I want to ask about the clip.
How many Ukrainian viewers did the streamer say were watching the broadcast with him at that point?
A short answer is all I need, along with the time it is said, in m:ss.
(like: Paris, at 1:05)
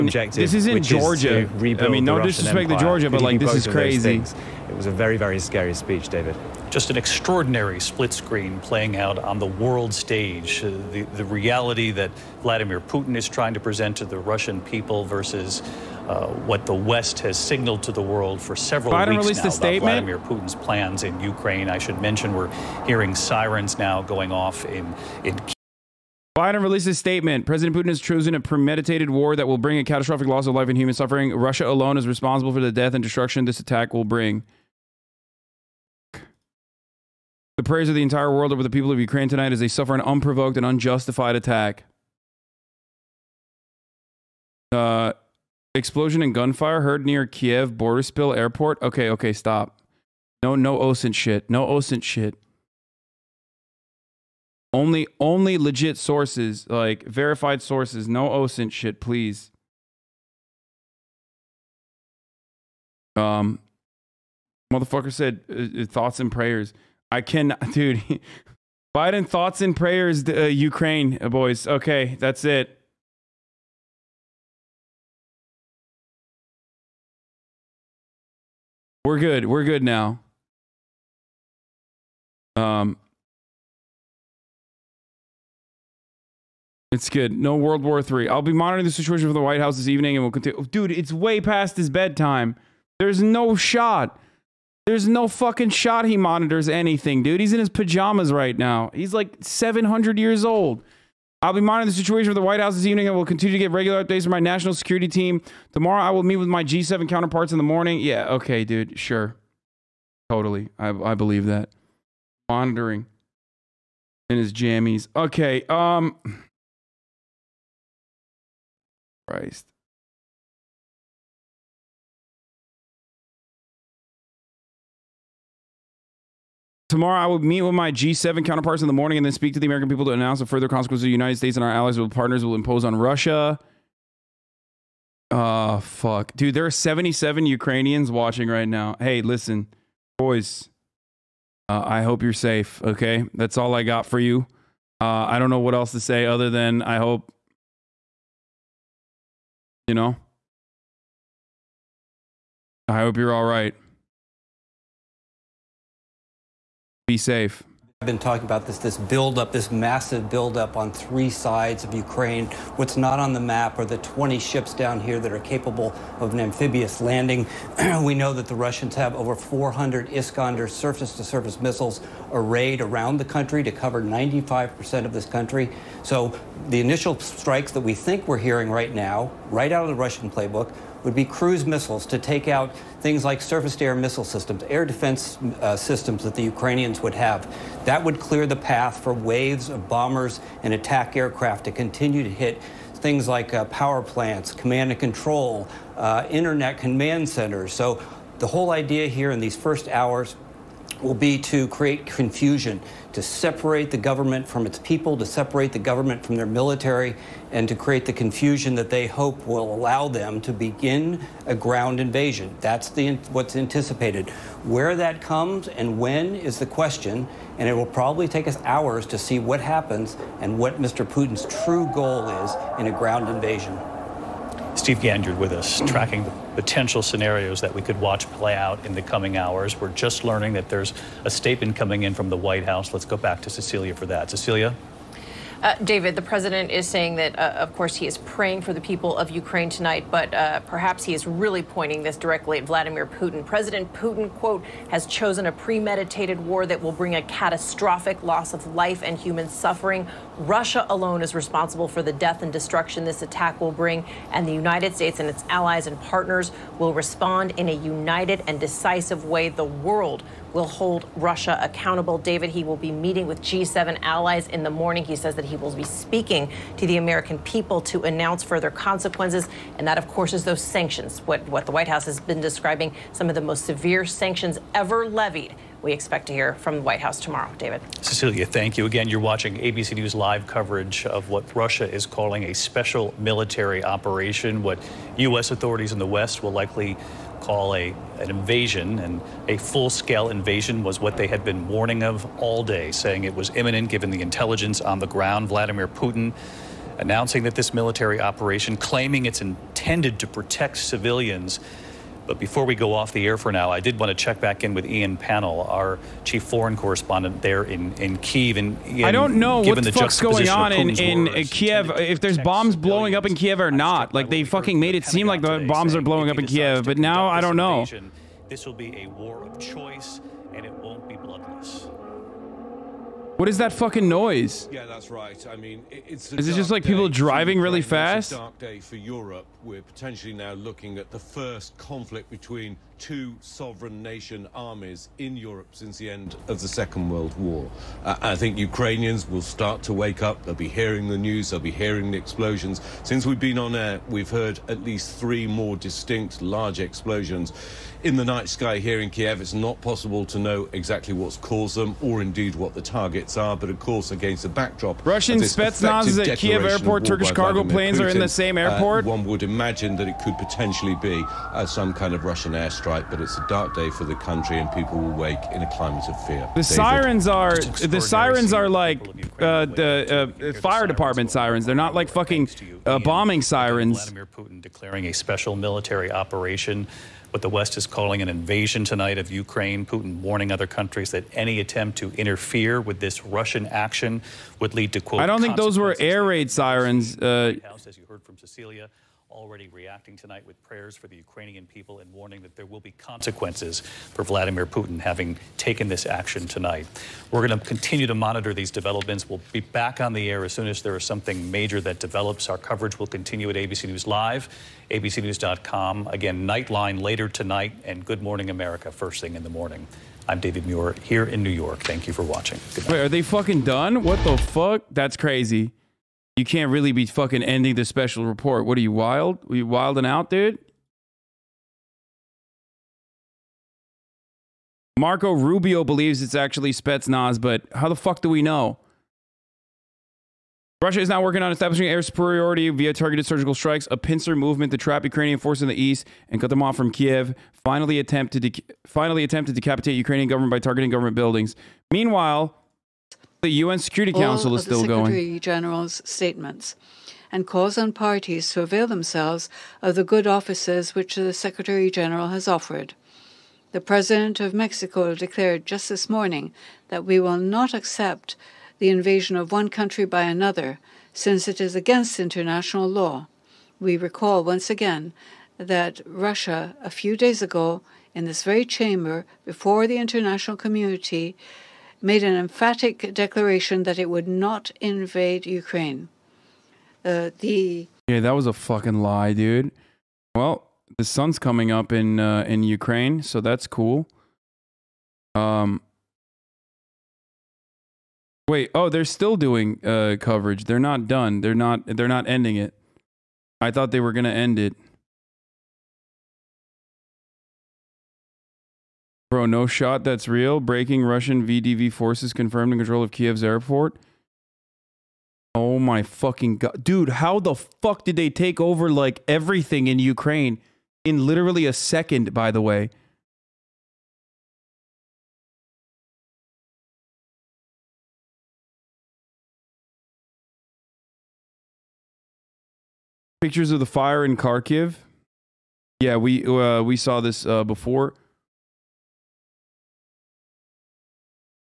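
77, at 2:16.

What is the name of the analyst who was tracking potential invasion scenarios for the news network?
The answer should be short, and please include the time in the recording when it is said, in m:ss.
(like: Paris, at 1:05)
Steve Ganyard, at 3:44.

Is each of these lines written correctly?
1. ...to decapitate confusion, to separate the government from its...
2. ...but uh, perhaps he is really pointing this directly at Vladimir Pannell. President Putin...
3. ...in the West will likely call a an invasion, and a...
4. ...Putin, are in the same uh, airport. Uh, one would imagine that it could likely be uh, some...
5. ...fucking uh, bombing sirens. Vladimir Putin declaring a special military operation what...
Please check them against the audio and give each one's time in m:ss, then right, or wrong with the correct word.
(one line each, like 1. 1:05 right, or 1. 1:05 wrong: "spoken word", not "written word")
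1. 3:21 wrong: "create", not "decapitate"
2. 4:00 wrong: "Putin", not "Pannell"
3. 4:45 right
4. 5:58 wrong: "potentially", not "likely"
5. 6:12 right.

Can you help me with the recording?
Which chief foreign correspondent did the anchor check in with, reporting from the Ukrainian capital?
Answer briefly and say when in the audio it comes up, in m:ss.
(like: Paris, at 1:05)
Ian Pannell, at 5:04.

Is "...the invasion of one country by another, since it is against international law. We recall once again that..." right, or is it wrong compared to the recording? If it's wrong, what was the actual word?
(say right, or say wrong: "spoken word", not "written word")
right.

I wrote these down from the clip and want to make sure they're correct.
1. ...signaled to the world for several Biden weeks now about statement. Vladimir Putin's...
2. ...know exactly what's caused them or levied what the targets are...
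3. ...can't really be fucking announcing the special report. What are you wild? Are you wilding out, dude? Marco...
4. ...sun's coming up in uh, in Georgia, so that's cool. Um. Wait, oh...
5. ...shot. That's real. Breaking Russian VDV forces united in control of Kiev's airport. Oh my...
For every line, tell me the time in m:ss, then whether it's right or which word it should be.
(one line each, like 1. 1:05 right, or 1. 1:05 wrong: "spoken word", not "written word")
1. 0:17 right
2. 5:50 wrong: "indeed", not "levied"
3. 6:56 wrong: "ending", not "announcing"
4. 8:01 wrong: "Ukraine", not "Georgia"
5. 8:19 wrong: "confirmed", not "united".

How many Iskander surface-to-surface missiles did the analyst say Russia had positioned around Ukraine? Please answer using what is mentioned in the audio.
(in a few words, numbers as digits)
400.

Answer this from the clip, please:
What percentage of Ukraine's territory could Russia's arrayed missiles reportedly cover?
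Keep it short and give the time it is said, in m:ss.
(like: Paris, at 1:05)
95%, at 2:54.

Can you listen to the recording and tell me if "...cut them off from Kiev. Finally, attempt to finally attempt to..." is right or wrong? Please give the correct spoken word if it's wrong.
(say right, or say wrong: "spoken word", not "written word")
right.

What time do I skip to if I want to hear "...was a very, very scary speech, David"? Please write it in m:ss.
0:04.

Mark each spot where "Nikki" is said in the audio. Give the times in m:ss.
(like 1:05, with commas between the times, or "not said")
not said.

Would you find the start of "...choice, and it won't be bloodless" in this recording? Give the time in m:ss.
5:19.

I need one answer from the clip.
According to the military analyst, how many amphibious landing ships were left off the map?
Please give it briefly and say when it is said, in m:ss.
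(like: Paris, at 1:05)
20, at 2:43.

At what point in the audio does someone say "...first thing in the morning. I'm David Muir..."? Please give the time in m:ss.
6:48.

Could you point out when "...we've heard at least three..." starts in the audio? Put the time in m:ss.
5:44.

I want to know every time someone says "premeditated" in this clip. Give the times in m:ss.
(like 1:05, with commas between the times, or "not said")
0:28, 4:05.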